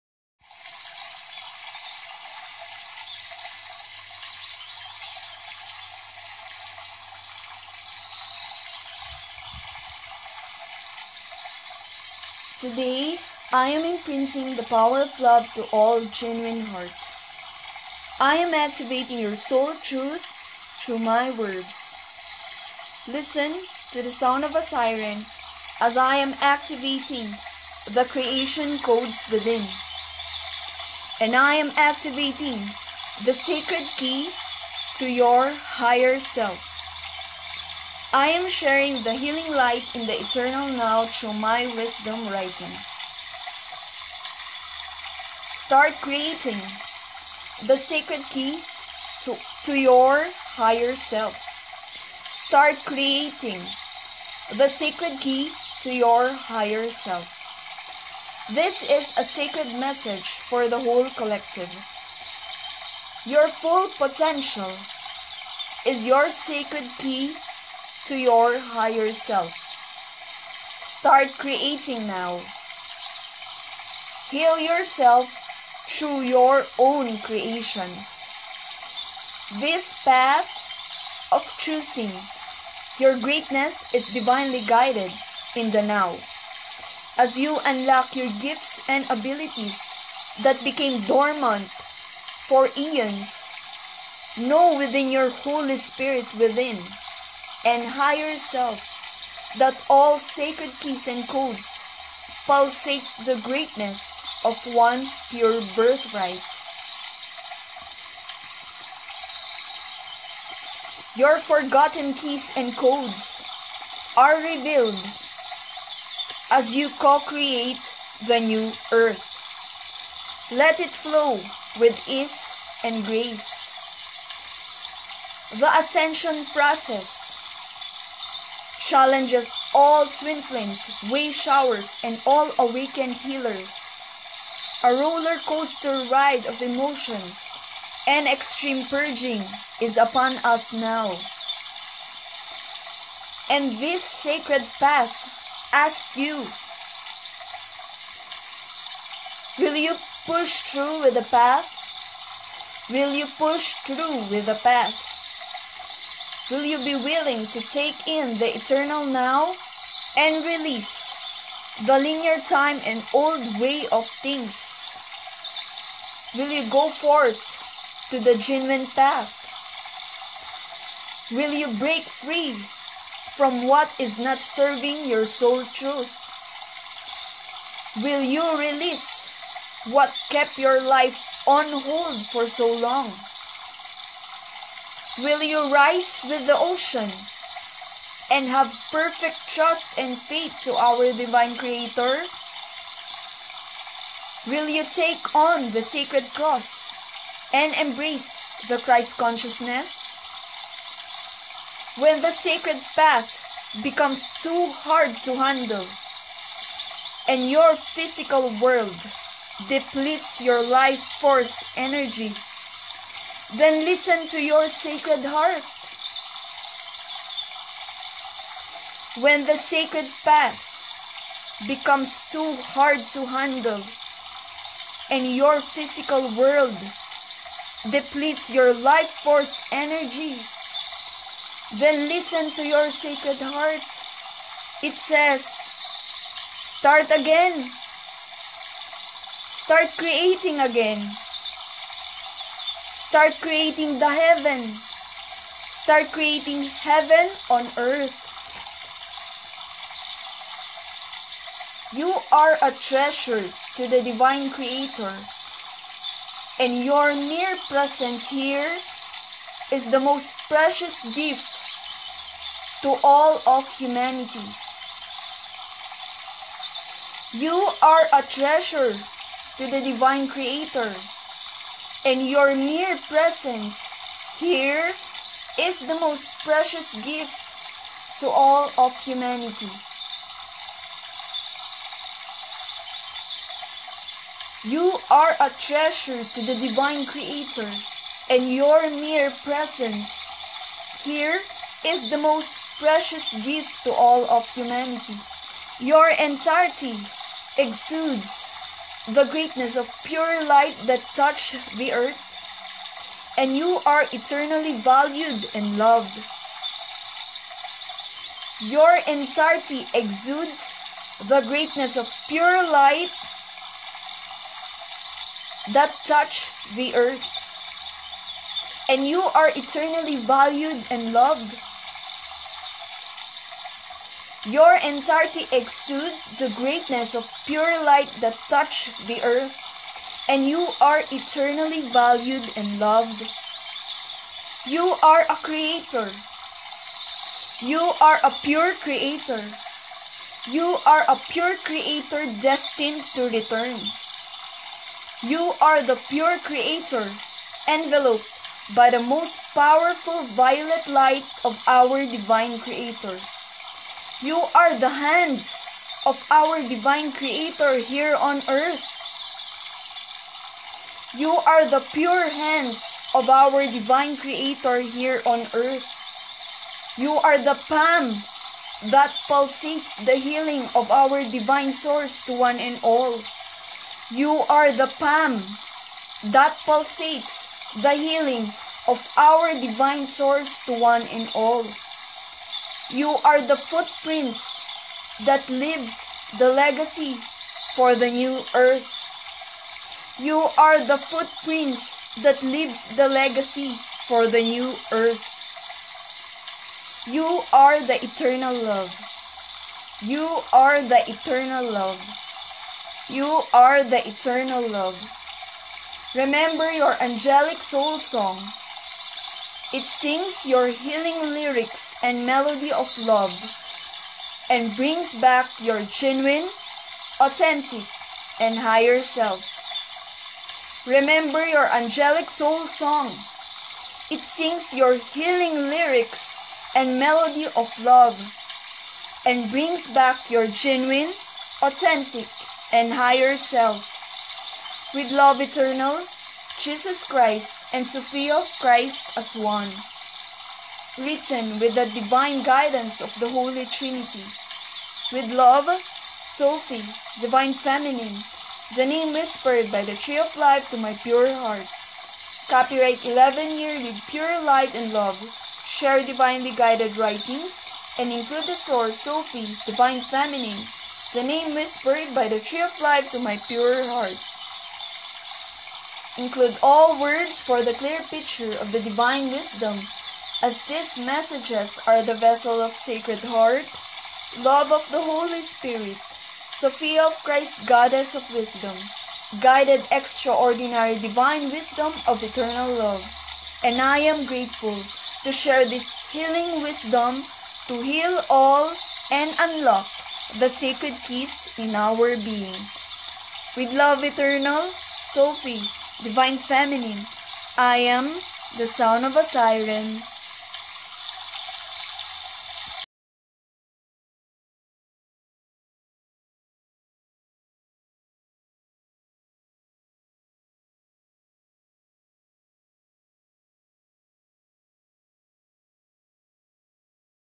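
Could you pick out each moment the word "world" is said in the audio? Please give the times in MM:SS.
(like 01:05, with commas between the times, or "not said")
03:28, 03:46.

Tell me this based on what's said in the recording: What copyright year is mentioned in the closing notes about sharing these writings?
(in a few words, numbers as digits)
11 year.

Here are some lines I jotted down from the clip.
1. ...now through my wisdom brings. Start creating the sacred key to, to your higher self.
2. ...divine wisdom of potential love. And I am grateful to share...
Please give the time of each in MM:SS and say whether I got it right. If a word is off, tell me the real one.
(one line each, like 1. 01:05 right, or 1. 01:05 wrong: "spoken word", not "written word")
1. 00:40 wrong: "writings", not "brings"
2. 08:00 wrong: "eternal", not "potential".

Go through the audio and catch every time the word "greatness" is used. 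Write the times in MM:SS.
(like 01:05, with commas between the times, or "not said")
01:23, 01:43, 04:59, 05:11, 05:26.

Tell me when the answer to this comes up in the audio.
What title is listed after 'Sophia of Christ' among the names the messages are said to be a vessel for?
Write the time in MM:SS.
07:57.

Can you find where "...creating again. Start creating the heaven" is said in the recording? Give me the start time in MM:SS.
03:59.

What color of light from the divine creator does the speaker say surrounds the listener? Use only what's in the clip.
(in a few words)
Violet.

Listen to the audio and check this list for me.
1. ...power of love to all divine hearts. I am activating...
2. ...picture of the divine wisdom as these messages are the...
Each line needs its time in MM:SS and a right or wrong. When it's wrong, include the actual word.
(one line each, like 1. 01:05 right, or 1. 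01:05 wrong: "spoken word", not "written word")
1. 00:14 wrong: "genuine", not "divine"
2. 07:48 right.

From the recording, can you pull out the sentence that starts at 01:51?
Your forgotten keys and codes are revealed as you co create the new earth.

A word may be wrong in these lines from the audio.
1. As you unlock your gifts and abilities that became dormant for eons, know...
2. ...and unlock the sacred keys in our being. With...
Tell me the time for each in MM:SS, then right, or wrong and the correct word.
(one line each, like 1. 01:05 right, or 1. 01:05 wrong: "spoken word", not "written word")
1. 01:27 right
2. 08:09 right.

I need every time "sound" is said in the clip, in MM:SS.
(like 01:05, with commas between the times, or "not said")
00:24, 08:18.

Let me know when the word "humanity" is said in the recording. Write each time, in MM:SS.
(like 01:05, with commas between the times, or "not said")
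04:23, 04:38, 04:54.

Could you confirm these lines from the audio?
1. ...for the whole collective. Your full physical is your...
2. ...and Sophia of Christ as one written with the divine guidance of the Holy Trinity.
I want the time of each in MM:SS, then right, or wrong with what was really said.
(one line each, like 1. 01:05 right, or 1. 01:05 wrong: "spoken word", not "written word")
1. 01:00 wrong: "potential", not "physical"
2. 07:17 right.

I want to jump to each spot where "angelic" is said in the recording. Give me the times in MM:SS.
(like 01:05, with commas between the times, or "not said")
06:47, 07:01.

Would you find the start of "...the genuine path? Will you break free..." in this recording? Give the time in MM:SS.
02:48.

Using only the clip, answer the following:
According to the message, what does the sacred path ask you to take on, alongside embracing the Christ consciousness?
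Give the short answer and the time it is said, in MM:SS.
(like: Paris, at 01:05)
The sacred cross, at 03:15.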